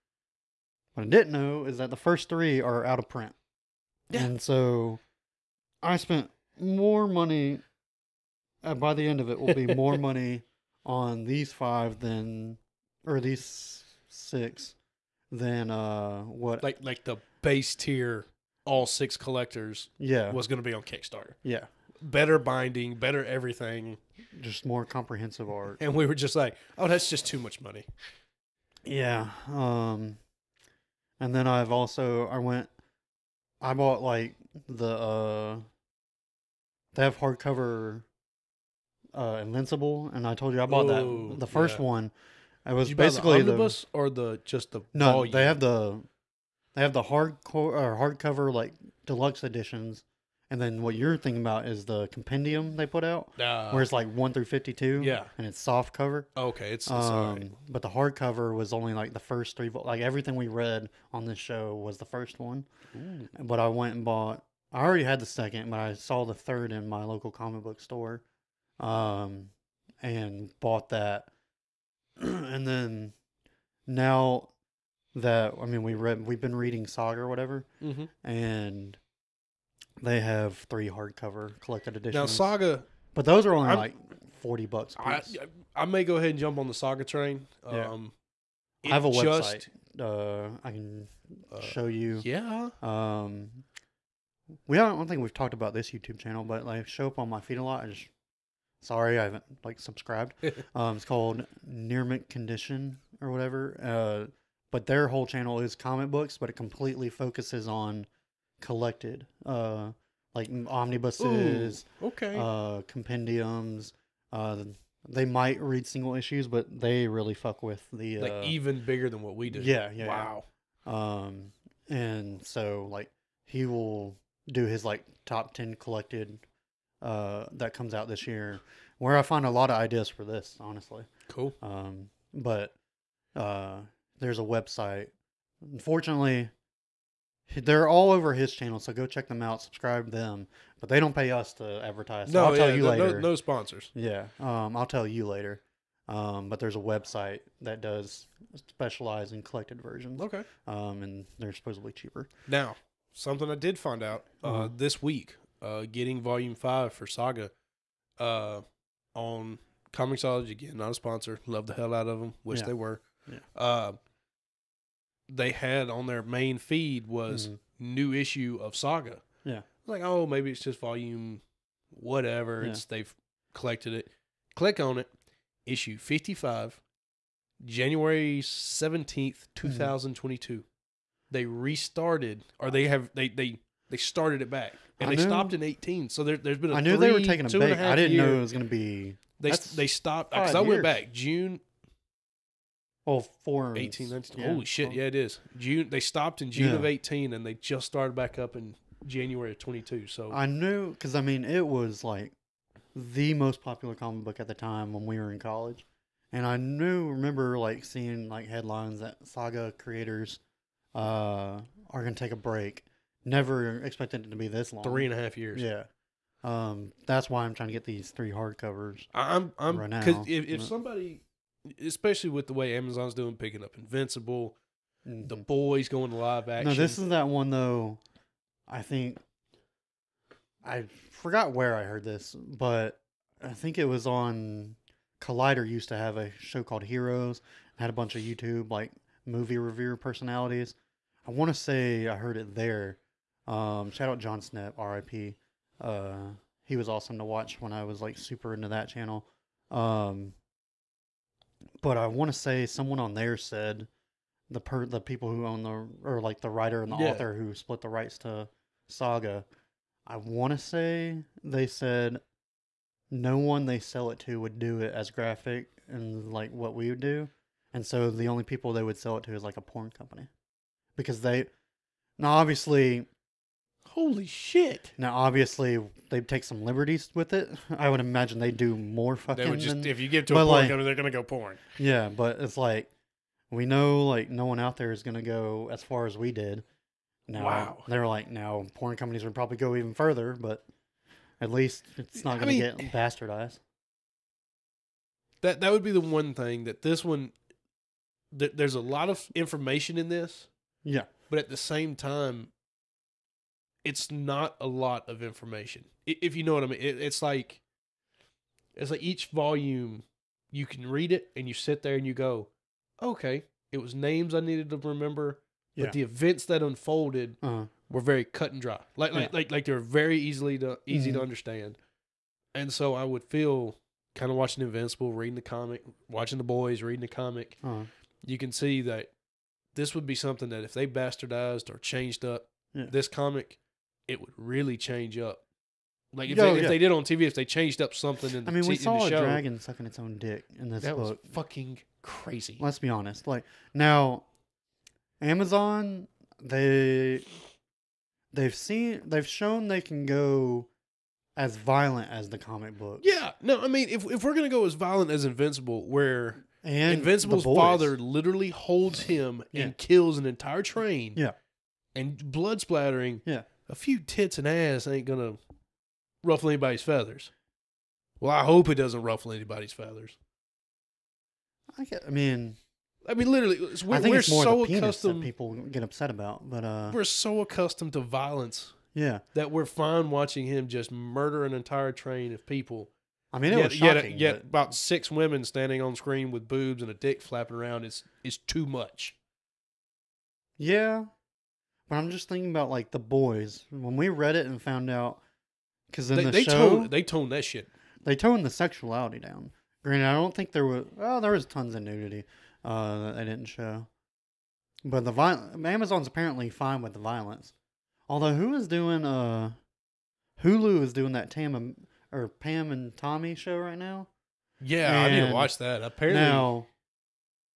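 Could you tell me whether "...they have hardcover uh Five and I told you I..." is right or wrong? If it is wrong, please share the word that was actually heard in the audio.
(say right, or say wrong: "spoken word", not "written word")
wrong: "Invincible", not "Five".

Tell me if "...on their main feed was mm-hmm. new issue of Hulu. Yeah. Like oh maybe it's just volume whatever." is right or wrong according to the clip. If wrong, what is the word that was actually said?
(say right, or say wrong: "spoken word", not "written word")
wrong: "Saga", not "Hulu".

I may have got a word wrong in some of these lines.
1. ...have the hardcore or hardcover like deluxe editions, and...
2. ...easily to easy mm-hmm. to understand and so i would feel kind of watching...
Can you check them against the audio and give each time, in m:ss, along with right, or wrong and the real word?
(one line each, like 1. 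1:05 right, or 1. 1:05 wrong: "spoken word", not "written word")
1. 0:46 right
2. 5:20 right.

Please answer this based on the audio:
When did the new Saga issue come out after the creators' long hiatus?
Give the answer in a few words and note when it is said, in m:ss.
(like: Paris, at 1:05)
January 17th, 2022, at 2:57.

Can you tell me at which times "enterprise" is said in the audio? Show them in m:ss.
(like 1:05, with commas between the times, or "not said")
not said.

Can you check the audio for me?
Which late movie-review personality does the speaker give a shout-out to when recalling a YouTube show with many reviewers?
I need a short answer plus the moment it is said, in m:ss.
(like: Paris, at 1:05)
Jon Schnepp, at 4:04.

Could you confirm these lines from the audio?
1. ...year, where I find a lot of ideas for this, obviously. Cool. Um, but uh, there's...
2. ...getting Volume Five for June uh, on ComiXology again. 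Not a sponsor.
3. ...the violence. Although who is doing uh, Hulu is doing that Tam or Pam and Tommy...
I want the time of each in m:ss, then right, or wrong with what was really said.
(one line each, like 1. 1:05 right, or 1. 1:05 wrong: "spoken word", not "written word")
1. 2:08 wrong: "honestly", not "obviously"
2. 2:35 wrong: "Saga", not "June"
3. 6:46 right.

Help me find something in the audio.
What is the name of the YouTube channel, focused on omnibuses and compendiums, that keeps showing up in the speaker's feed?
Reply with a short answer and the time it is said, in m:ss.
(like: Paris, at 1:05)
Mint Condition, at 1:41.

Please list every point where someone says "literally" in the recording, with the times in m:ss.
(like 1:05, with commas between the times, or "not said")
5:57, 6:13.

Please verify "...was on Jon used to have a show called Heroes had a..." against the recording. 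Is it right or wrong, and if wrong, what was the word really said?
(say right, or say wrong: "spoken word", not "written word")
wrong: "Collider", not "Jon".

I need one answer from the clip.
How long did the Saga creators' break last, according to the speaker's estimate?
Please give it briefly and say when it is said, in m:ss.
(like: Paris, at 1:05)
Three and a half years, at 3:34.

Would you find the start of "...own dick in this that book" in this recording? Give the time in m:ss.
5:39.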